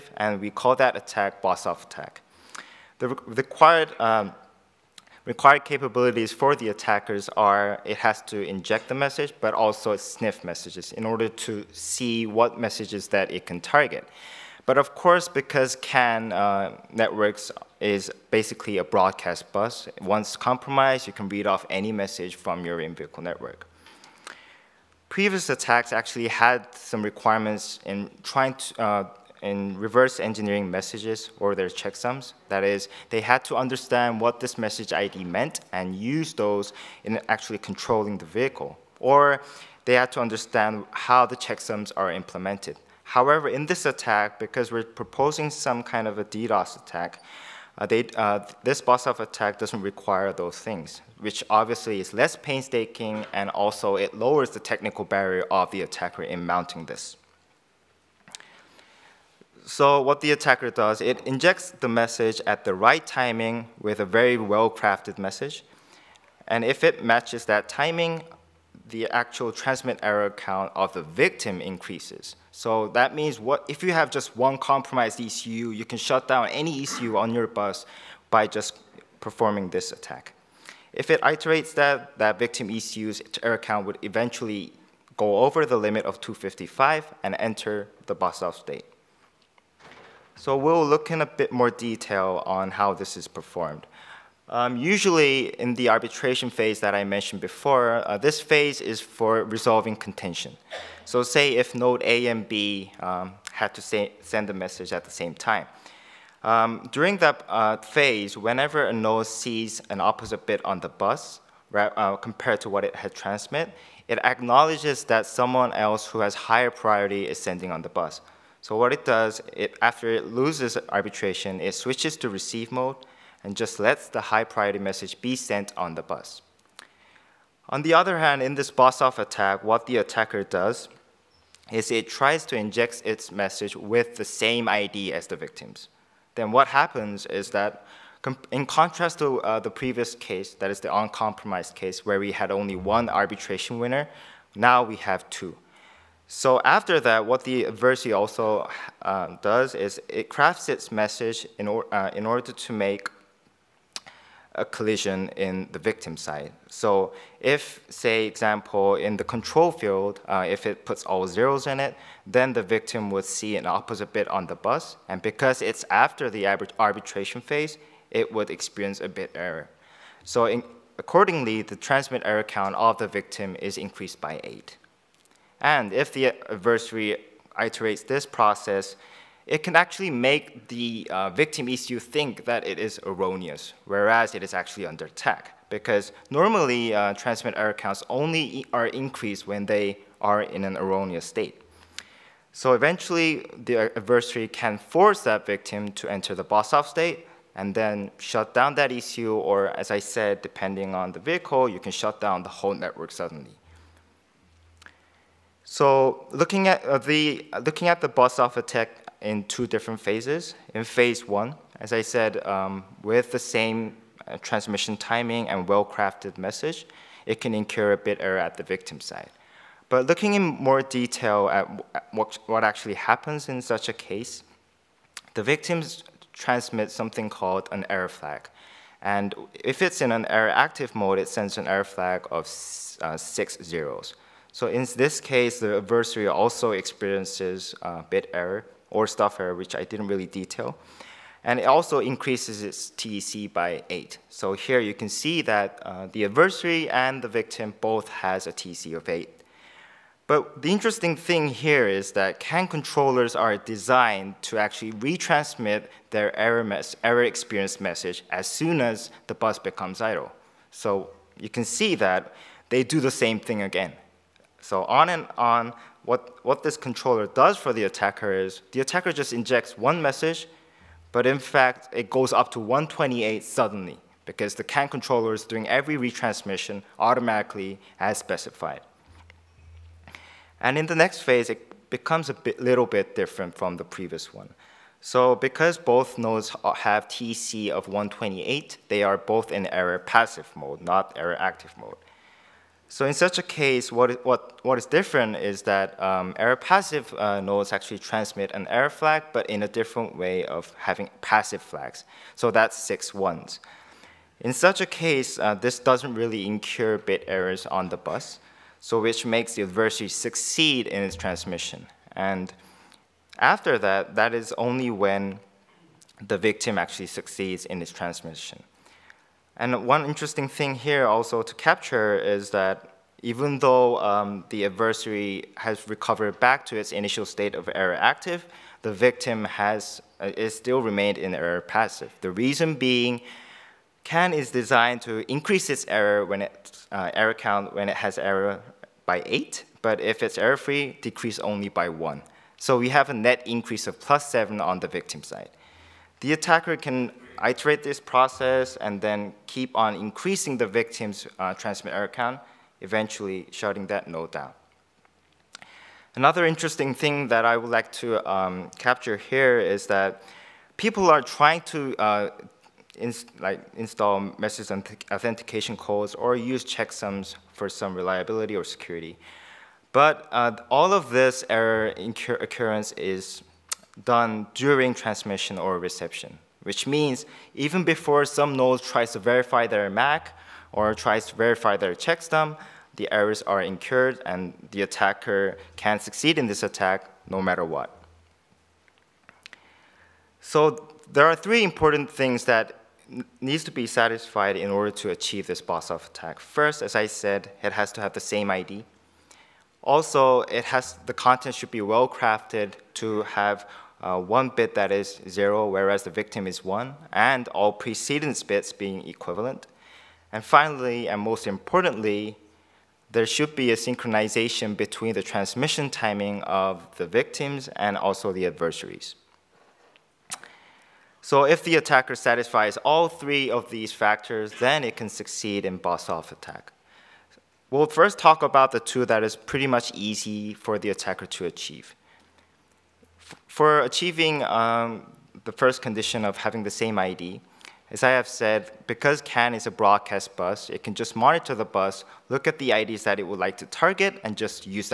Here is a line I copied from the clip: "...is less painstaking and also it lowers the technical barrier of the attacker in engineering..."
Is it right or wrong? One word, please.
wrong.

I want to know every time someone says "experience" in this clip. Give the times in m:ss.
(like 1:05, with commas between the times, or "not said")
2:48, 3:56, 4:17.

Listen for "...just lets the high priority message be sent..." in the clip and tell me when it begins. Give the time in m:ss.
2:03.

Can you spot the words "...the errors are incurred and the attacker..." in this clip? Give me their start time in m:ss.
6:22.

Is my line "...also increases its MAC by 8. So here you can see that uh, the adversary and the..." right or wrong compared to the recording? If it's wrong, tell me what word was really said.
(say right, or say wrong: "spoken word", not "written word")
wrong: "TEC", not "MAC".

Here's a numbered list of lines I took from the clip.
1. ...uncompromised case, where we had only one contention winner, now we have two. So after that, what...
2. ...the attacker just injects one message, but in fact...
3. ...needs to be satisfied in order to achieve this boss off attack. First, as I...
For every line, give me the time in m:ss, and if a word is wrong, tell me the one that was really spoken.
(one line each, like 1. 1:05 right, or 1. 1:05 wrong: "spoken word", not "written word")
1. 2:20 wrong: "arbitration", not "contention"
2. 4:28 right
3. 6:33 right.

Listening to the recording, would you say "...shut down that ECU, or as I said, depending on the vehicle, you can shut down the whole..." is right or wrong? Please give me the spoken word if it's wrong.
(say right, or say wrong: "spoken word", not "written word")
right.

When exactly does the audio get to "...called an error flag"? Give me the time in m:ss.
3:47.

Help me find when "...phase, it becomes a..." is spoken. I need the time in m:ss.
4:41.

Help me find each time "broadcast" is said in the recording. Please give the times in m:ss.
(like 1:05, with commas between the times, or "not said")
0:18, 7:19.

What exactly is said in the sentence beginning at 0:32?
That is, they had to understand what this message ID meant and use those in actually controlling the vehicle.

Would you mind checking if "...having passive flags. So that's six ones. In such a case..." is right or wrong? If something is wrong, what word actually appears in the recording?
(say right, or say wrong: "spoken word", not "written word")
right.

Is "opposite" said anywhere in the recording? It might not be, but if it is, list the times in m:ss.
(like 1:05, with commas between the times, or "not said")
1:49, 2:43.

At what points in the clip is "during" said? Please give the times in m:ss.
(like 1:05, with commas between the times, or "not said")
1:46, 6:14.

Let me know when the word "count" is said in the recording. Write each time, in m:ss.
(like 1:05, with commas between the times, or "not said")
1:10, 1:23, 2:52, 3:07, 5:37, 5:52.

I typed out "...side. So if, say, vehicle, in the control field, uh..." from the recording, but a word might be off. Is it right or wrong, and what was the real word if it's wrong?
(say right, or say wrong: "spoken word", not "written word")
wrong: "example", not "vehicle".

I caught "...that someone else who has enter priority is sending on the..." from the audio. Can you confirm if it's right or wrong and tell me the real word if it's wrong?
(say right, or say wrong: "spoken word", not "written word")
wrong: "higher", not "enter".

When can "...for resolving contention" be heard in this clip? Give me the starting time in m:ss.
1:38.